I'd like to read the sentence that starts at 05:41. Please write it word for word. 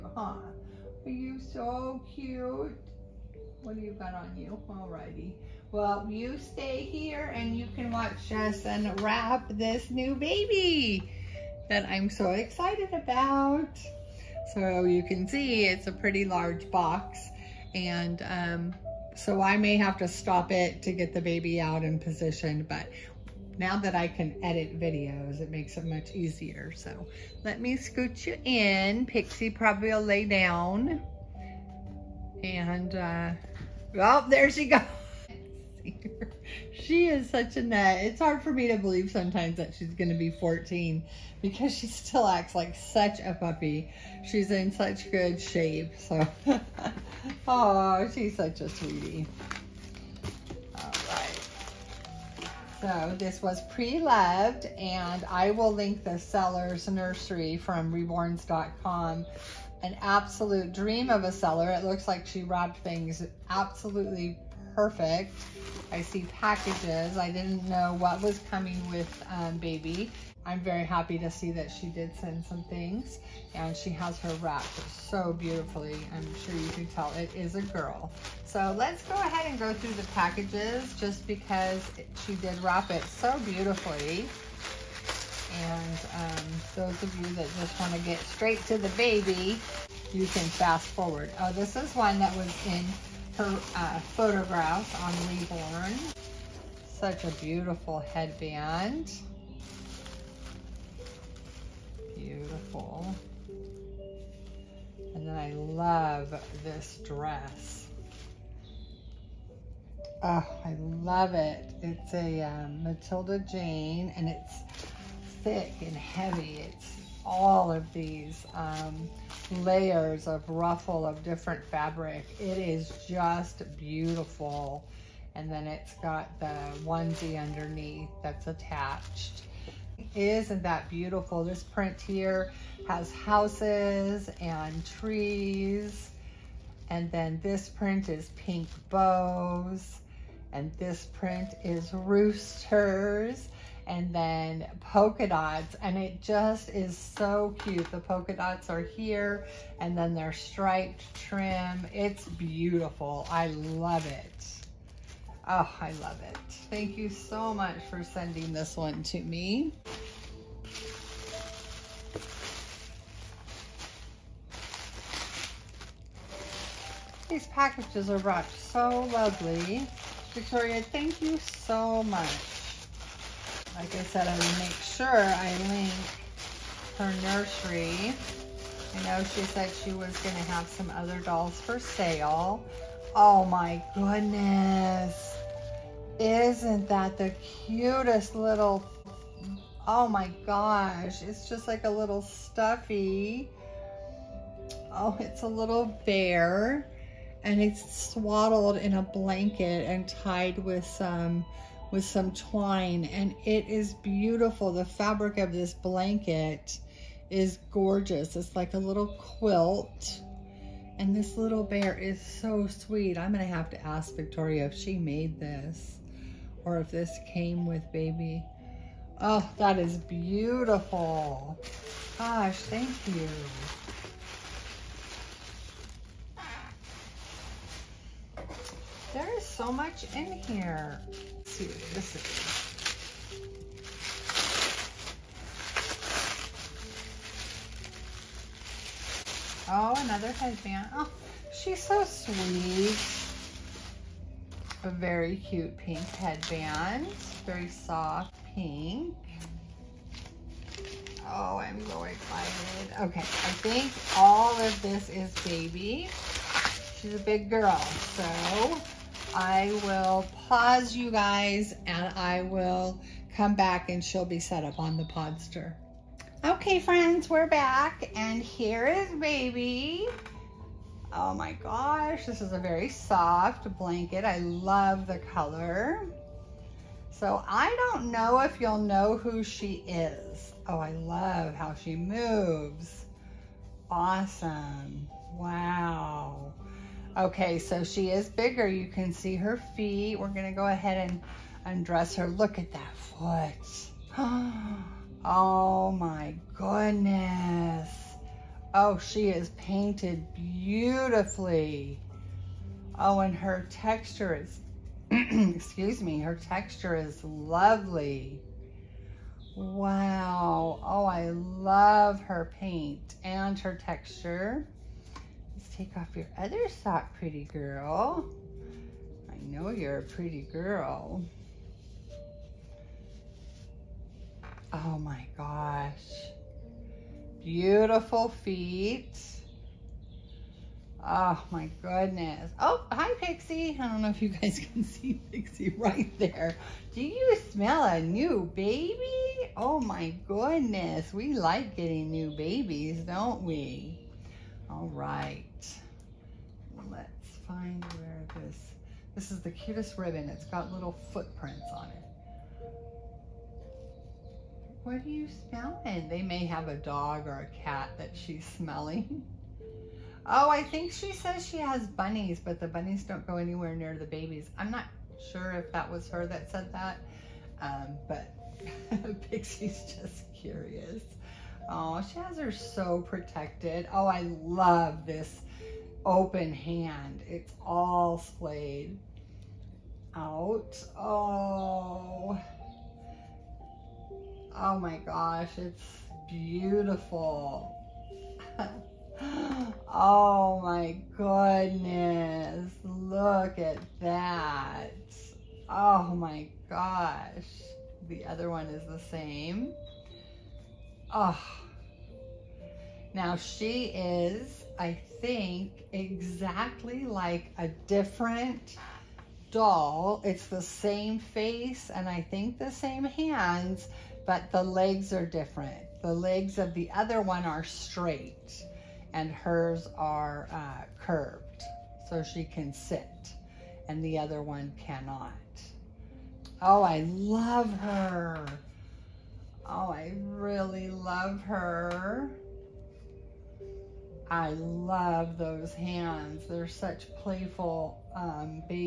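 We like getting new babies, don't we?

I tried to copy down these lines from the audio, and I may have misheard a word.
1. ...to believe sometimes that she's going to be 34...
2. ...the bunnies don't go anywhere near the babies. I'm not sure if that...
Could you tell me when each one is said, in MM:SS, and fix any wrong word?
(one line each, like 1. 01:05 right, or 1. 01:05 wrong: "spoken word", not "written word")
1. 00:38 wrong: "14", not "34"
2. 06:02 right.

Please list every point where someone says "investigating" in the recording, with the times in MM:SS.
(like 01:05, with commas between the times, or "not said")
not said.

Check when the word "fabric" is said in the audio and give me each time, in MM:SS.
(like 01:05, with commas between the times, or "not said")
02:01, 03:24.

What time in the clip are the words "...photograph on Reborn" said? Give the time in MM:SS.
01:33.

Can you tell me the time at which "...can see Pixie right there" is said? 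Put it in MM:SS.
05:34.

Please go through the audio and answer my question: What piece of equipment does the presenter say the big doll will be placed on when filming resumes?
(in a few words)
Podster.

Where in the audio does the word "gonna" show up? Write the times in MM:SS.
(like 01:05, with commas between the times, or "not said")
03:33, 04:50.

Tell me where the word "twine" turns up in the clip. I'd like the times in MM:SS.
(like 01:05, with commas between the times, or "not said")
03:22.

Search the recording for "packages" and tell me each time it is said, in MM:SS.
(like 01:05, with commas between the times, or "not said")
01:06, 01:20, 02:47.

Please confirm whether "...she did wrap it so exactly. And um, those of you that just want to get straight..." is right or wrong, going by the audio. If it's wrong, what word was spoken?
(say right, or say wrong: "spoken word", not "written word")
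wrong: "beautifully", not "exactly".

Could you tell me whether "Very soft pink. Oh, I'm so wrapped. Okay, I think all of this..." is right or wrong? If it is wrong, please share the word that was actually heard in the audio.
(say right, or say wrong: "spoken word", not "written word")
wrong: "excited", not "wrapped".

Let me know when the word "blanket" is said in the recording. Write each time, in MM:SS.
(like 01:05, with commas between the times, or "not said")
03:19, 03:25, 04:33.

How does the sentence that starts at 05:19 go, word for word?
I know you're a pretty girl.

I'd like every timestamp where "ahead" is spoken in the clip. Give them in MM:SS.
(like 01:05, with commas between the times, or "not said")
01:19, 04:50.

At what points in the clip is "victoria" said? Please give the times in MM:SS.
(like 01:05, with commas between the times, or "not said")
02:50, 03:34.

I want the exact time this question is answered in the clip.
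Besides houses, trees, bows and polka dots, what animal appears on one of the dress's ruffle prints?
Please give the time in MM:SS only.
02:21.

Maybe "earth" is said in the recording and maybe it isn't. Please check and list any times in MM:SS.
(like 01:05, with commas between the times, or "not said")
not said.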